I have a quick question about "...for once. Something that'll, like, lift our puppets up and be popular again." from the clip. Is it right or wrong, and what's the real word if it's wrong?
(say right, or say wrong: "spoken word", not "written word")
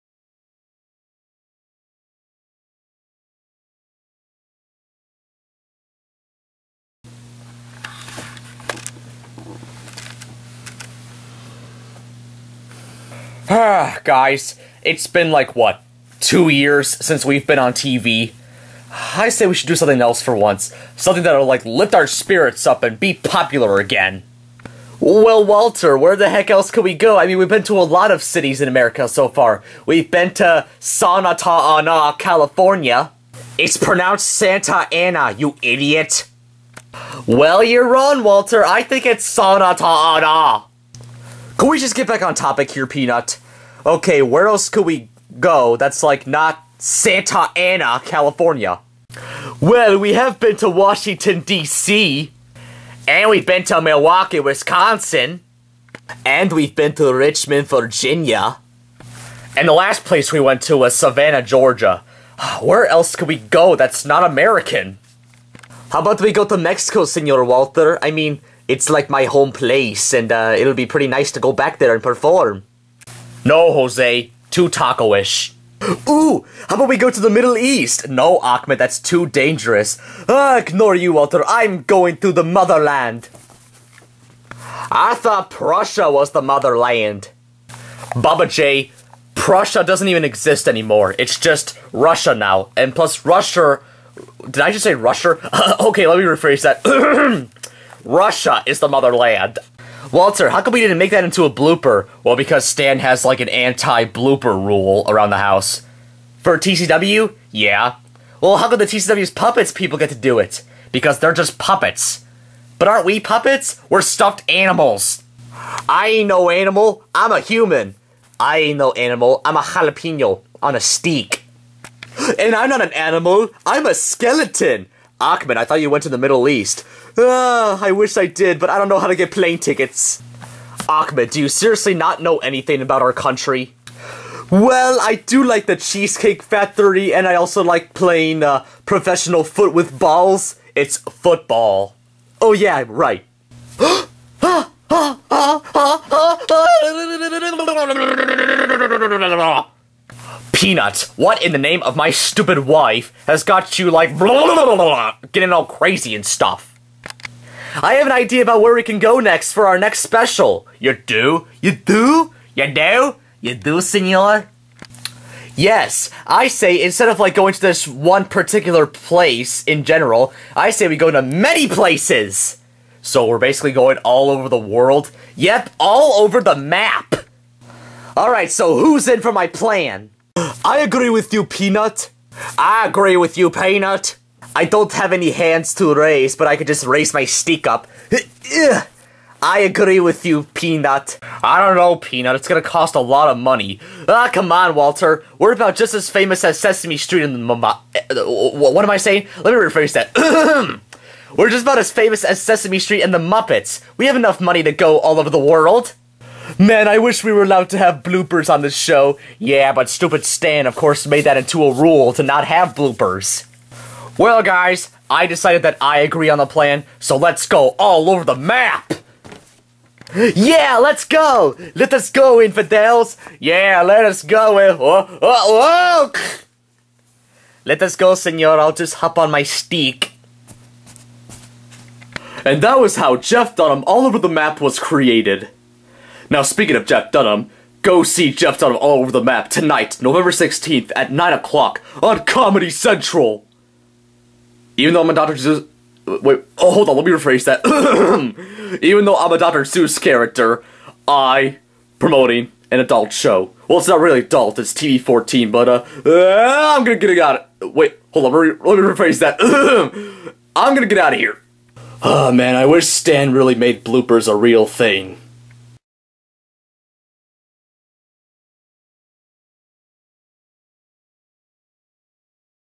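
wrong: "spirits", not "puppets".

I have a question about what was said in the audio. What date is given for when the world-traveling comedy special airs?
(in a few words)
November 16th.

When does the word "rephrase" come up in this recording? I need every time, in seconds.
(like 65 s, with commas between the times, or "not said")
96 s, 199 s, 247 s, 258 s.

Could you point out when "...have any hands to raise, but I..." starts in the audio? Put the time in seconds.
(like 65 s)
184 s.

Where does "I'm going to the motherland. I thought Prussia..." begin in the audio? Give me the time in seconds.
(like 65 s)
81 s.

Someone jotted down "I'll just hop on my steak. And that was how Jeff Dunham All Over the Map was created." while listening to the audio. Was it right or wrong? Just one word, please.
right.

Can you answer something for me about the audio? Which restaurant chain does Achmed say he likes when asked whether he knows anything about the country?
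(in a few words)
Cheesecake Factory.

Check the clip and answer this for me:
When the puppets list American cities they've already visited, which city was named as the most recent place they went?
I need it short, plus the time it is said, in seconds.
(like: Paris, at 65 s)
Savannah, Georgia, at 60 s.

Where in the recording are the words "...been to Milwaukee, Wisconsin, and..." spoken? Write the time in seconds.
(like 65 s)
53 s.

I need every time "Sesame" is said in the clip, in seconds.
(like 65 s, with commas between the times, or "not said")
196 s, 202 s.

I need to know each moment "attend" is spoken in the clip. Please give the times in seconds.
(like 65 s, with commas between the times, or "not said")
not said.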